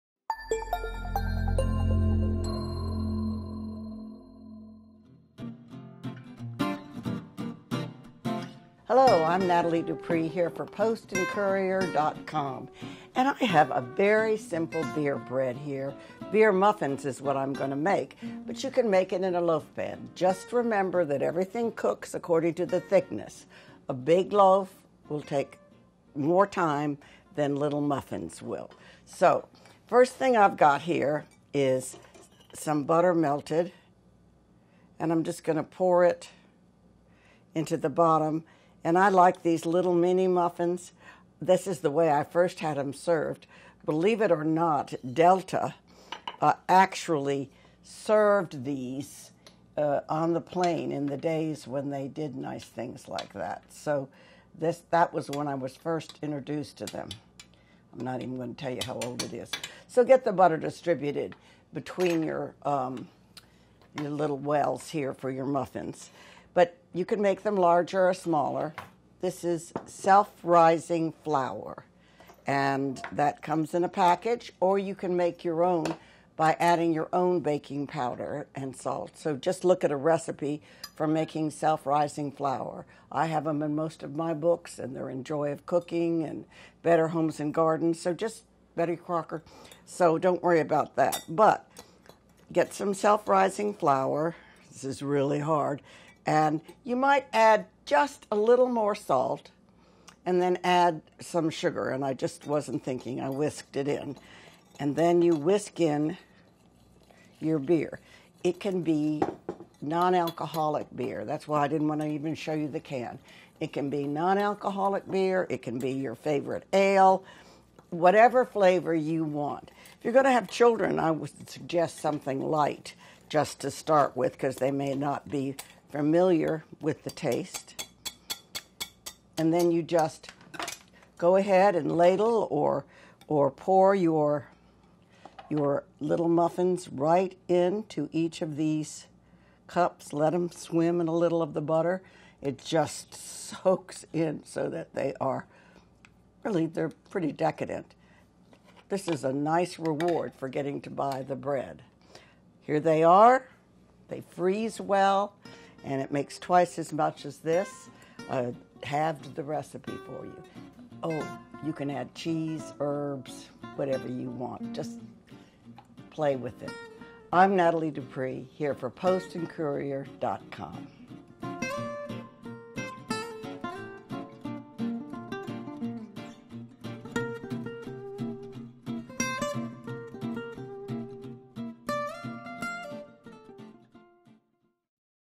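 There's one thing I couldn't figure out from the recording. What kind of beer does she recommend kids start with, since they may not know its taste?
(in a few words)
Something light.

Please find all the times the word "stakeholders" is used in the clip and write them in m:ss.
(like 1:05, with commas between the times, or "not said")
not said.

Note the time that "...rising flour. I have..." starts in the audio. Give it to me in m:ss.
1:21.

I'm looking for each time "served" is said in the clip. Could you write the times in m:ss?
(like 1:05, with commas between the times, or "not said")
0:42, 0:47.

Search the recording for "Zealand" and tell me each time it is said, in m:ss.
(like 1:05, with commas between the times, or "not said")
not said.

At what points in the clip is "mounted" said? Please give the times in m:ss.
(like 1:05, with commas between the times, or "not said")
not said.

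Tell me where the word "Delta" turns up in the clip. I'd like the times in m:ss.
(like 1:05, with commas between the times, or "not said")
0:45.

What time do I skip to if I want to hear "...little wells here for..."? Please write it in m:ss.
1:04.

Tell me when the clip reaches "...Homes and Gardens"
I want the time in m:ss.
1:27.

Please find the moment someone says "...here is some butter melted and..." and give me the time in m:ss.
0:30.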